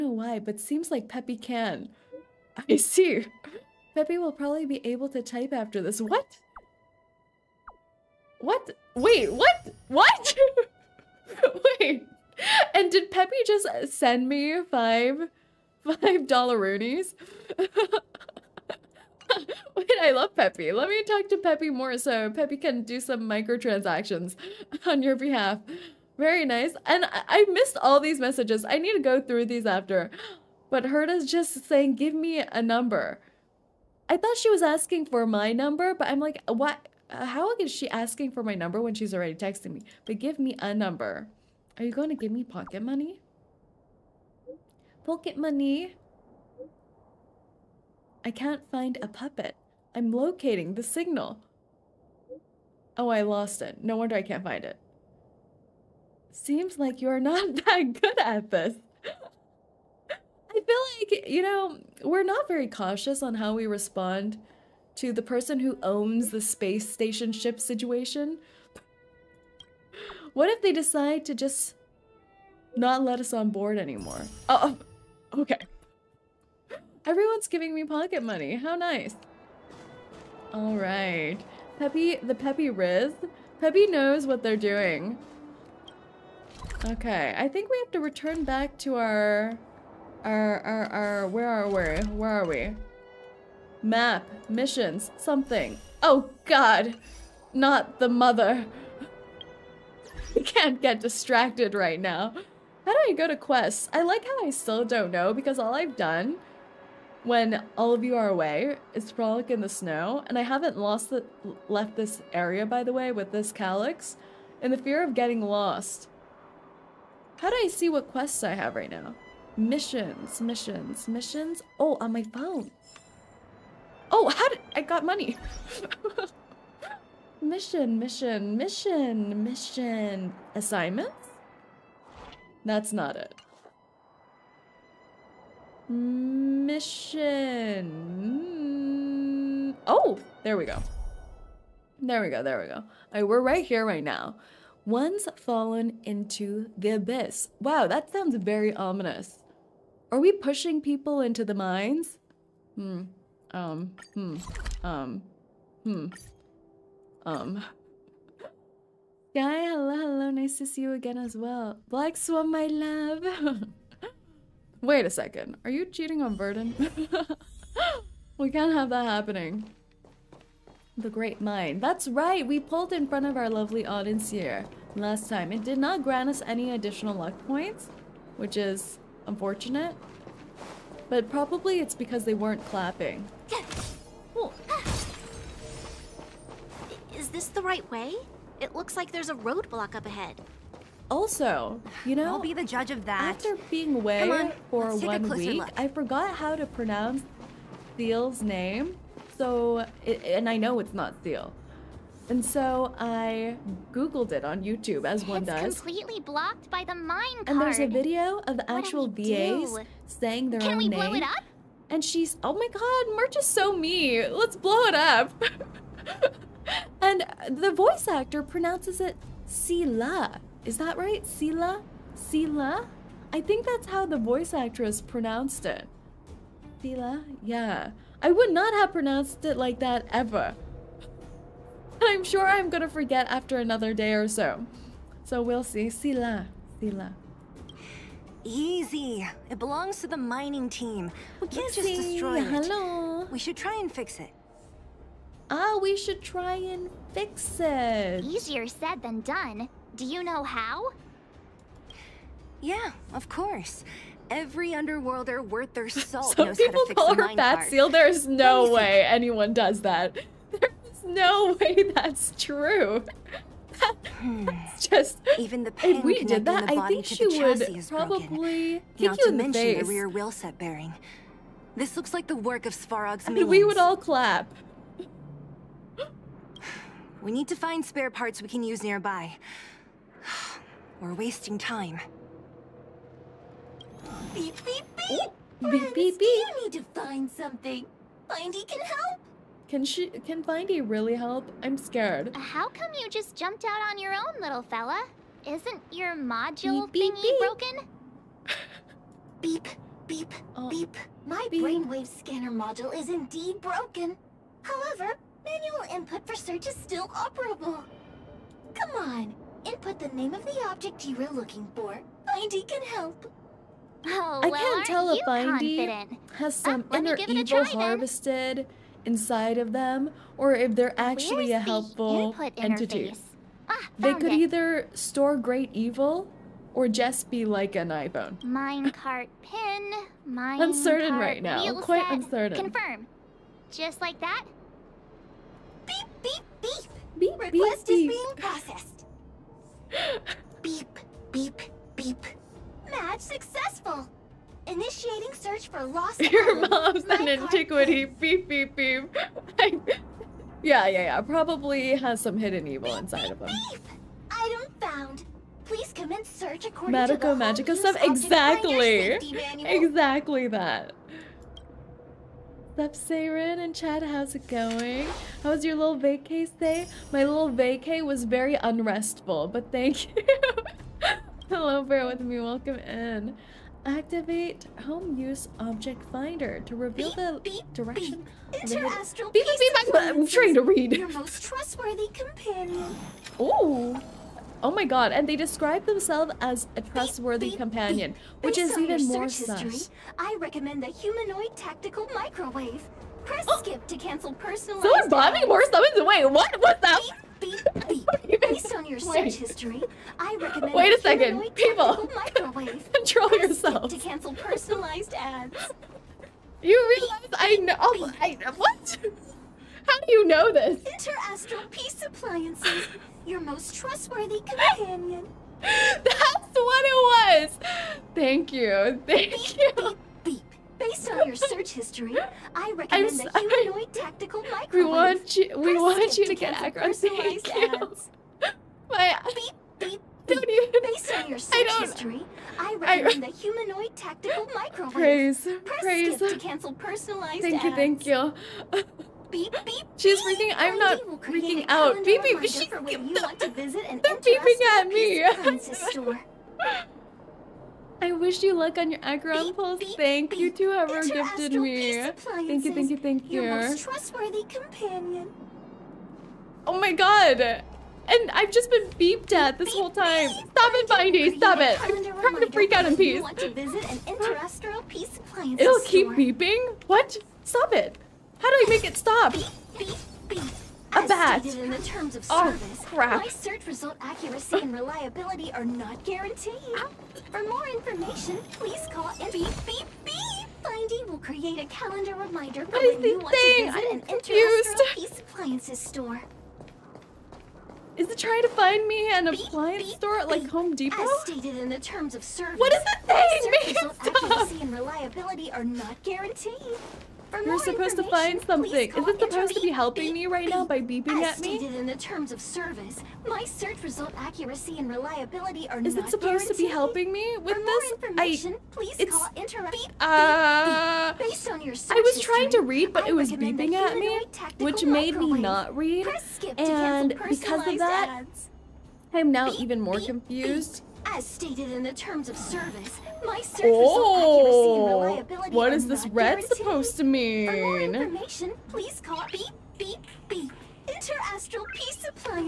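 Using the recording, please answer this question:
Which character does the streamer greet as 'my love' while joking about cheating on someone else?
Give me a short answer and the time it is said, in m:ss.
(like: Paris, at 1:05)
Black Swan, at 2:41.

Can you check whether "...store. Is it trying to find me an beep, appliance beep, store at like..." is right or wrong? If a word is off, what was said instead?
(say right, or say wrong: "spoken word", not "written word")
right.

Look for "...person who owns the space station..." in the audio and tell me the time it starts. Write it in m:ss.
1:05.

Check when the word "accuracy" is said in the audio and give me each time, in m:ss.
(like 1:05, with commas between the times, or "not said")
7:54, 8:14, 8:24, 8:45.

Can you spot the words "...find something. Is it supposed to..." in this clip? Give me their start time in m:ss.
8:18.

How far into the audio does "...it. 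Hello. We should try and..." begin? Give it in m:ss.
4:02.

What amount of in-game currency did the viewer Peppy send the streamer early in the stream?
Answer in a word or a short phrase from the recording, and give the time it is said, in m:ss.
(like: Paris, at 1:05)
5 dollar roonies, at 0:15.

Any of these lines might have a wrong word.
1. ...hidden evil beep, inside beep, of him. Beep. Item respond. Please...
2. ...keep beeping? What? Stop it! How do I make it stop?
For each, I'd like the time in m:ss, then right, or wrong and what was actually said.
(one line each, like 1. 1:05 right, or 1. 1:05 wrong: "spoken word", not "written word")
1. 5:52 wrong: "found", not "respond"
2. 7:45 right.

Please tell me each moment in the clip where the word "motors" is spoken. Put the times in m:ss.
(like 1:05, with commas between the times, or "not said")
not said.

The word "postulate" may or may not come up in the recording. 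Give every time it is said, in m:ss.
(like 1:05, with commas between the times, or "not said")
not said.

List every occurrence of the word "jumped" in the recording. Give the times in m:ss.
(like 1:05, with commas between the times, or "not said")
4:53.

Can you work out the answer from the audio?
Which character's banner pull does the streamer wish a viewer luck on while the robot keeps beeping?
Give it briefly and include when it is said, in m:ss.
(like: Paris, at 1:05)
Acheron, at 7:29.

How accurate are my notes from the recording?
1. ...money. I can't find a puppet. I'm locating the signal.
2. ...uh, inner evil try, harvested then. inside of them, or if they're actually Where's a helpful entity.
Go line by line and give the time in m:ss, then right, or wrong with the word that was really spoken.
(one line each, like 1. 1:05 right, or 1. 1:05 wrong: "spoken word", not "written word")
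1. 0:45 right
2. 5:16 right.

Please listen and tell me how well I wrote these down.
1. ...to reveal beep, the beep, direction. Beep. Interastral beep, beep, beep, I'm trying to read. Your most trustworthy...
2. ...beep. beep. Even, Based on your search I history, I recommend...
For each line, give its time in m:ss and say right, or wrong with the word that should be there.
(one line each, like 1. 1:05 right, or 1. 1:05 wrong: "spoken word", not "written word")
1. 6:16 right
2. 7:09 right.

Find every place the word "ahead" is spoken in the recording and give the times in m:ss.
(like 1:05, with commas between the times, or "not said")
3:10.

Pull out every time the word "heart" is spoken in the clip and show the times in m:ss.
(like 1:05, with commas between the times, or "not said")
not said.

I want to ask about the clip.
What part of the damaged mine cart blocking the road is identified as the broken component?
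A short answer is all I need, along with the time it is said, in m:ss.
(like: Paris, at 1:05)
rear wheel set bearing, at 4:29.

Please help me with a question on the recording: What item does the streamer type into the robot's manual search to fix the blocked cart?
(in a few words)
Minecart pin.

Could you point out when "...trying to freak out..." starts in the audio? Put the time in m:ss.
7:42.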